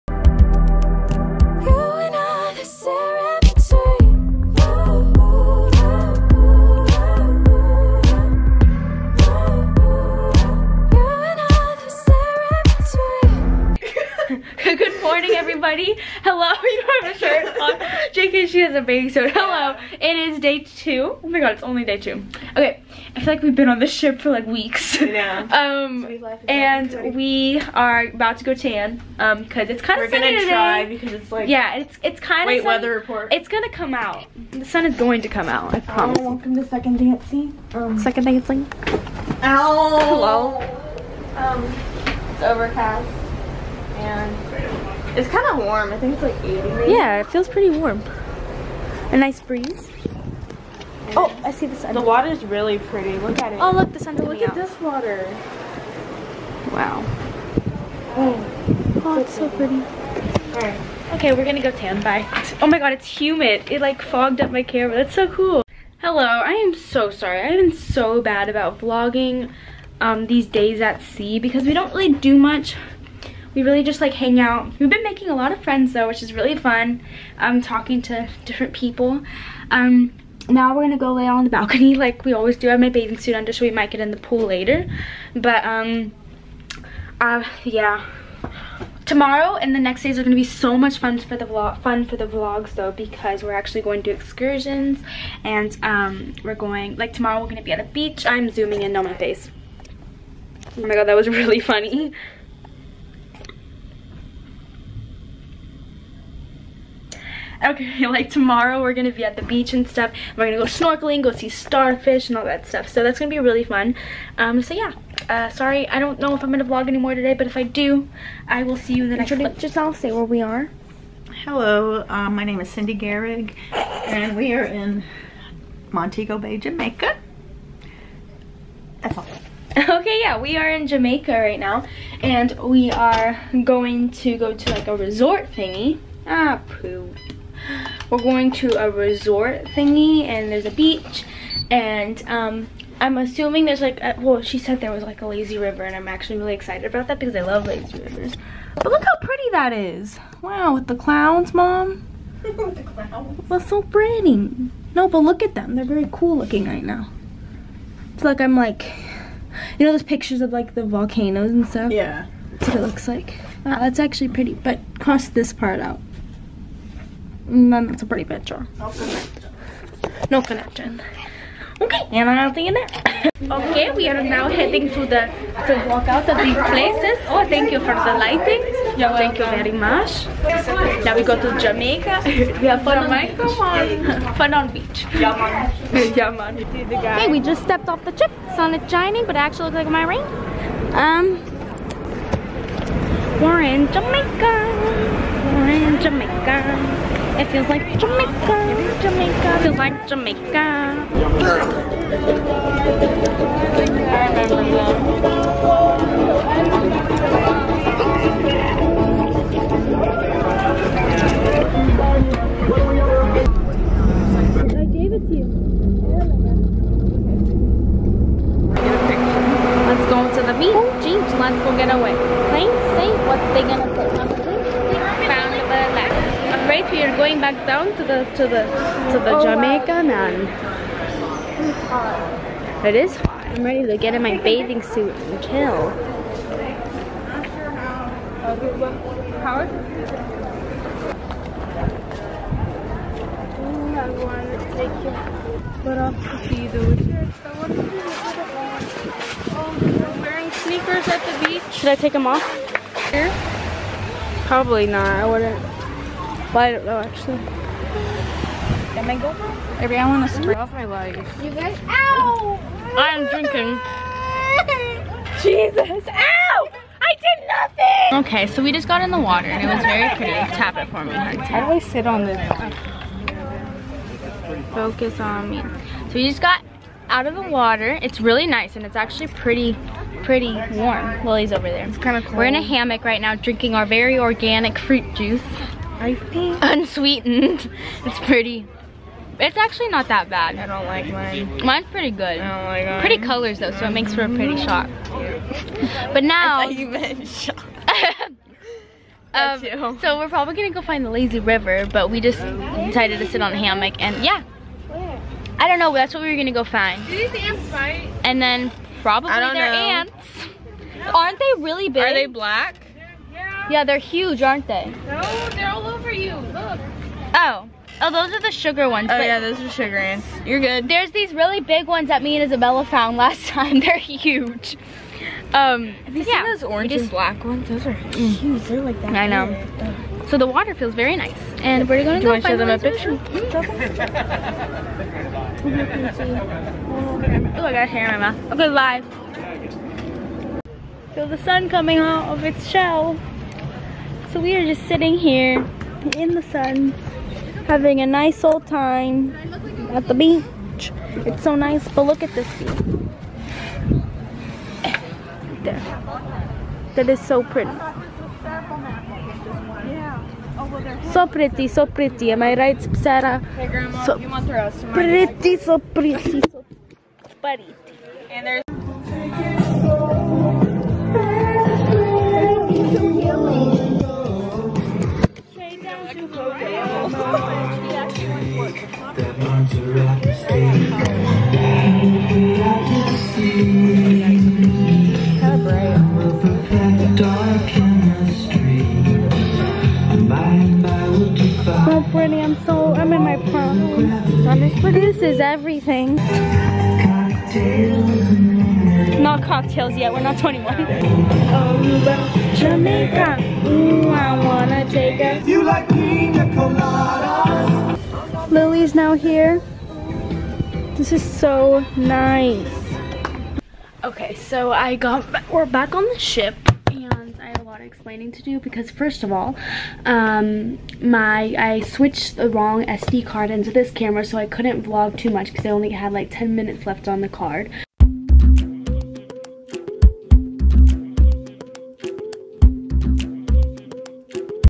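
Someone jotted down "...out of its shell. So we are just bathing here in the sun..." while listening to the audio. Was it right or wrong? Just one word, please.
wrong.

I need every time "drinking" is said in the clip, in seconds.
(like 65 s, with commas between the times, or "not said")
263 s, 283 s.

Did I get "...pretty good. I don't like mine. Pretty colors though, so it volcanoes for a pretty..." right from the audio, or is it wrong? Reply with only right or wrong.
wrong.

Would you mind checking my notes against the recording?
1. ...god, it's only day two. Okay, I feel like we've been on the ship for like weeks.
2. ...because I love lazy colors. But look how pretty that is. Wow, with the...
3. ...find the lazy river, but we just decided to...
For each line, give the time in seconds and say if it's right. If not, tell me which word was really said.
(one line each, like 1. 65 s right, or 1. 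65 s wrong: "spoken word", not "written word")
1. 21 s right
2. 147 s wrong: "rivers", not "colors"
3. 300 s right.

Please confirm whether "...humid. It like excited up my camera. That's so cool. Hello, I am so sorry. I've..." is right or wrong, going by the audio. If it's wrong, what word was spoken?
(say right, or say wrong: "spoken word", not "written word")
wrong: "fogged", not "excited".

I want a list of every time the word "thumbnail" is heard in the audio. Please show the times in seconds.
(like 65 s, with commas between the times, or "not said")
not said.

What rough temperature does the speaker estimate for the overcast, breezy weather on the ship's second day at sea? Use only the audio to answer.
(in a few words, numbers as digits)
80.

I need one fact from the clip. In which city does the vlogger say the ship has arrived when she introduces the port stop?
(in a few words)
Montego Bay.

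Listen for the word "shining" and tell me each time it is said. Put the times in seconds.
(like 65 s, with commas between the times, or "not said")
188 s.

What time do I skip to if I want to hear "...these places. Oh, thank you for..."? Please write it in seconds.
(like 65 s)
176 s.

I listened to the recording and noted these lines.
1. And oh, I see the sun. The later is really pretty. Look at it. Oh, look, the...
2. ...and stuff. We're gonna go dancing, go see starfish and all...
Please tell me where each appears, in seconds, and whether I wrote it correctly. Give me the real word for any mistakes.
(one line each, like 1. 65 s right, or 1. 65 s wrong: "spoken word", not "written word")
1. 51 s wrong: "water", not "later"
2. 109 s wrong: "snorkeling", not "dancing".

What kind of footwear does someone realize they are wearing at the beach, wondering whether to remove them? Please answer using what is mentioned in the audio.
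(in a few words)
sneakers.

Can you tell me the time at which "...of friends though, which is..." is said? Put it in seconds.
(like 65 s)
75 s.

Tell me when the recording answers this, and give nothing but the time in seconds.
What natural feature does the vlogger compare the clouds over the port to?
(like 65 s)
160 s.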